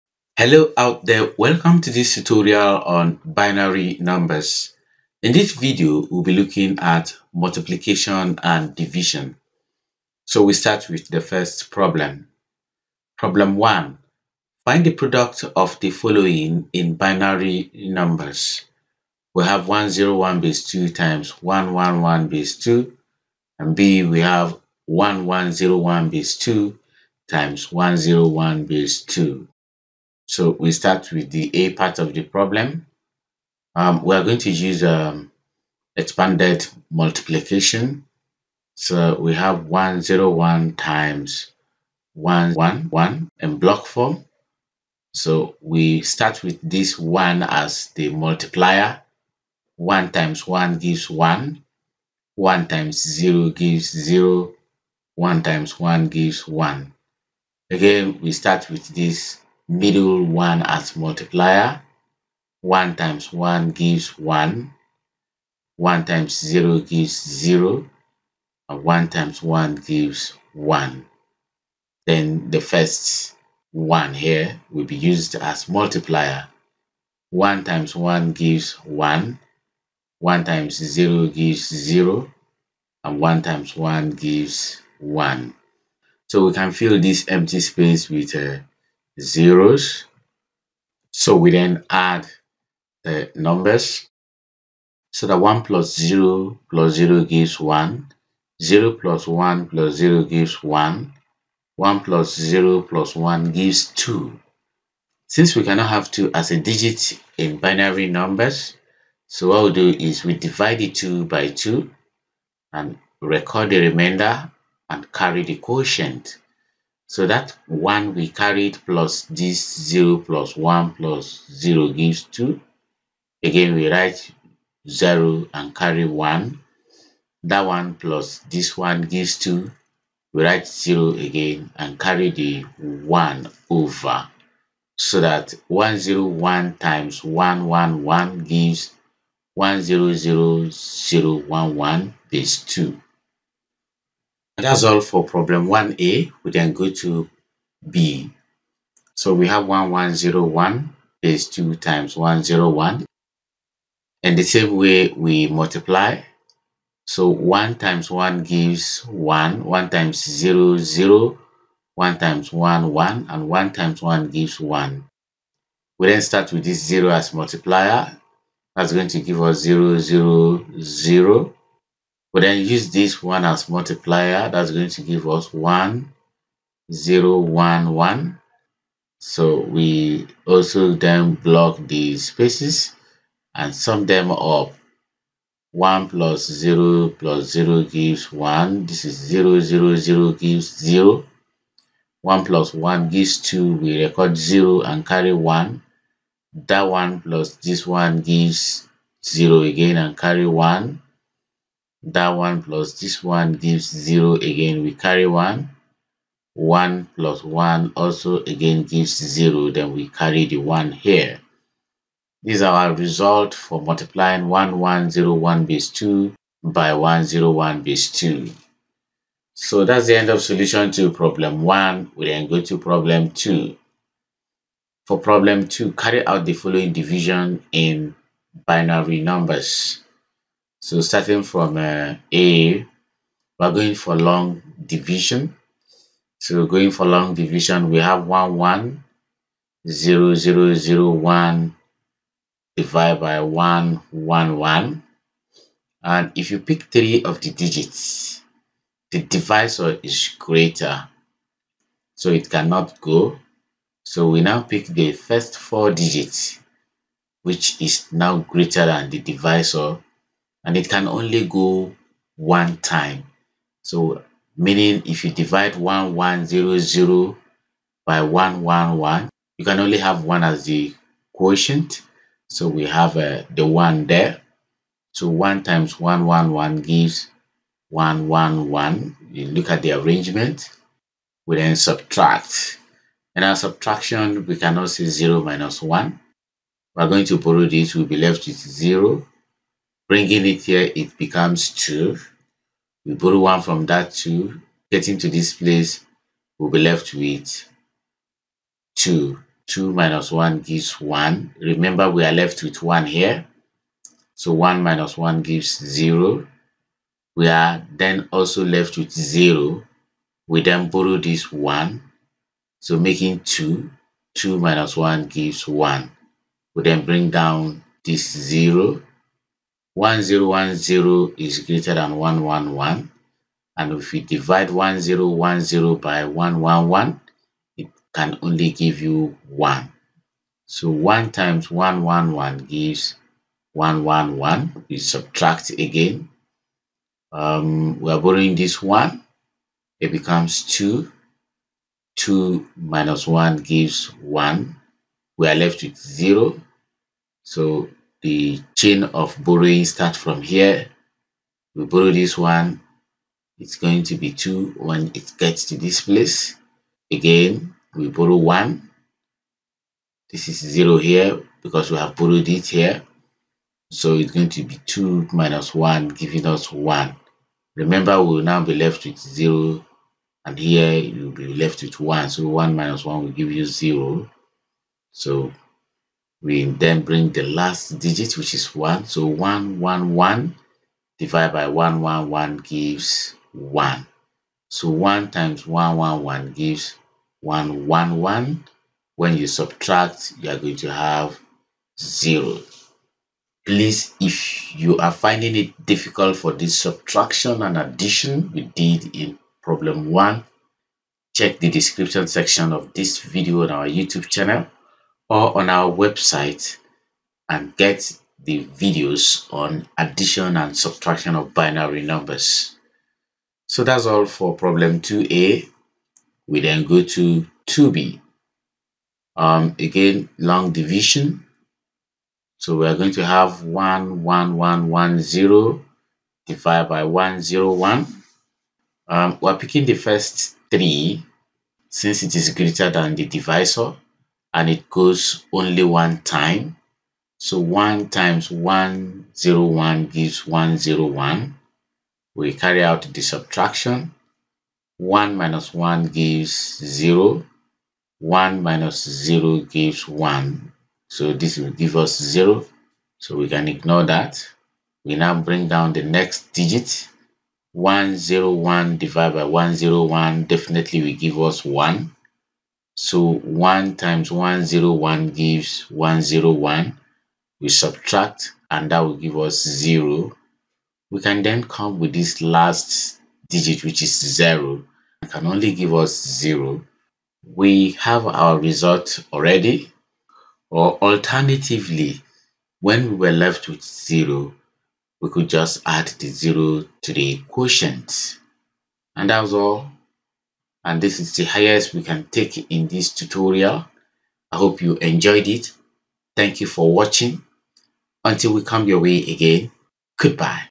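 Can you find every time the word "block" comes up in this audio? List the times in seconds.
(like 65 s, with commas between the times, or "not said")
43 s, 181 s.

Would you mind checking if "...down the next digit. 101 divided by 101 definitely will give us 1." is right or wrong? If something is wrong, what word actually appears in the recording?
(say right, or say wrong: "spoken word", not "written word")
right.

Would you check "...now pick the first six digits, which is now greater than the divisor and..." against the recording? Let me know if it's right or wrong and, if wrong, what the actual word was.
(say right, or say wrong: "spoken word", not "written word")
wrong: "four", not "six".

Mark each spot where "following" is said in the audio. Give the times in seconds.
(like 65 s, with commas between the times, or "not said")
15 s, 226 s.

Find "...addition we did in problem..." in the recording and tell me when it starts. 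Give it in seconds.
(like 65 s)
397 s.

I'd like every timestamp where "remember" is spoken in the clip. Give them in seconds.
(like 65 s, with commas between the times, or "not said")
301 s, 367 s.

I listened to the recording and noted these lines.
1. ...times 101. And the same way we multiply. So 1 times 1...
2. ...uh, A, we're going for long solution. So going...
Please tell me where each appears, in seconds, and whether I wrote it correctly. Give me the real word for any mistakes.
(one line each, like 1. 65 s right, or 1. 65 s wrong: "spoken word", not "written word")
1. 151 s right
2. 231 s wrong: "division", not "solution".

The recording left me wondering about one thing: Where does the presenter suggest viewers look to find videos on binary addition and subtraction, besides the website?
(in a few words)
YouTube channel.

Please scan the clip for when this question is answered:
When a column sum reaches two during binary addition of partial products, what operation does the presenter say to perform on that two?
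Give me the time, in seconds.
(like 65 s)
110 s.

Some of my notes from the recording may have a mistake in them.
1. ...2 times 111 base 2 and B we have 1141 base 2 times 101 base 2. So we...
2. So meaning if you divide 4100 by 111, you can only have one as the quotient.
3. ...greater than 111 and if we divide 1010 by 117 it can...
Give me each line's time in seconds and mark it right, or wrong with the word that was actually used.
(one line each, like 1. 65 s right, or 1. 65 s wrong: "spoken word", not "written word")
1. 20 s wrong: "1101", not "1141"
2. 263 s wrong: "1100", not "4100"
3. 321 s wrong: "111", not "117".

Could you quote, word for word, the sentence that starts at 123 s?
Again, we write 0 and carry 1.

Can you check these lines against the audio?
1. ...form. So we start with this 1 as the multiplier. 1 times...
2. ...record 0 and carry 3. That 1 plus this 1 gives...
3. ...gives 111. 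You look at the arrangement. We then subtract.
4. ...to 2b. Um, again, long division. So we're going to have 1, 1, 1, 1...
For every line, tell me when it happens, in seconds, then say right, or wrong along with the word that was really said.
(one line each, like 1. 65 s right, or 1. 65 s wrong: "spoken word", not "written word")
1. 43 s right
2. 194 s wrong: "1", not "3"
3. 276 s right
4. 417 s right.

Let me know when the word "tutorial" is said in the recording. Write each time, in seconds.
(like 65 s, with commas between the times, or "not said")
2 s, 493 s.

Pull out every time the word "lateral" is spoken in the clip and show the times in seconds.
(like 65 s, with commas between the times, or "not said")
not said.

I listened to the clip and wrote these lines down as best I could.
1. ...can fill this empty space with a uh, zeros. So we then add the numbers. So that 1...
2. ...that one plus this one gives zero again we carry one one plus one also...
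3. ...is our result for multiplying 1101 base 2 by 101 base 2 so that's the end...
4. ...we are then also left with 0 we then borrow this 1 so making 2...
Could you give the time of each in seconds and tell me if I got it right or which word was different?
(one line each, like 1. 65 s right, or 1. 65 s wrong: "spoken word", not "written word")
1. 86 s right
2. 202 s right
3. 212 s right
4. 307 s right.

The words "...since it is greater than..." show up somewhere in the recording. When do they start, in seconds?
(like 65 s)
431 s.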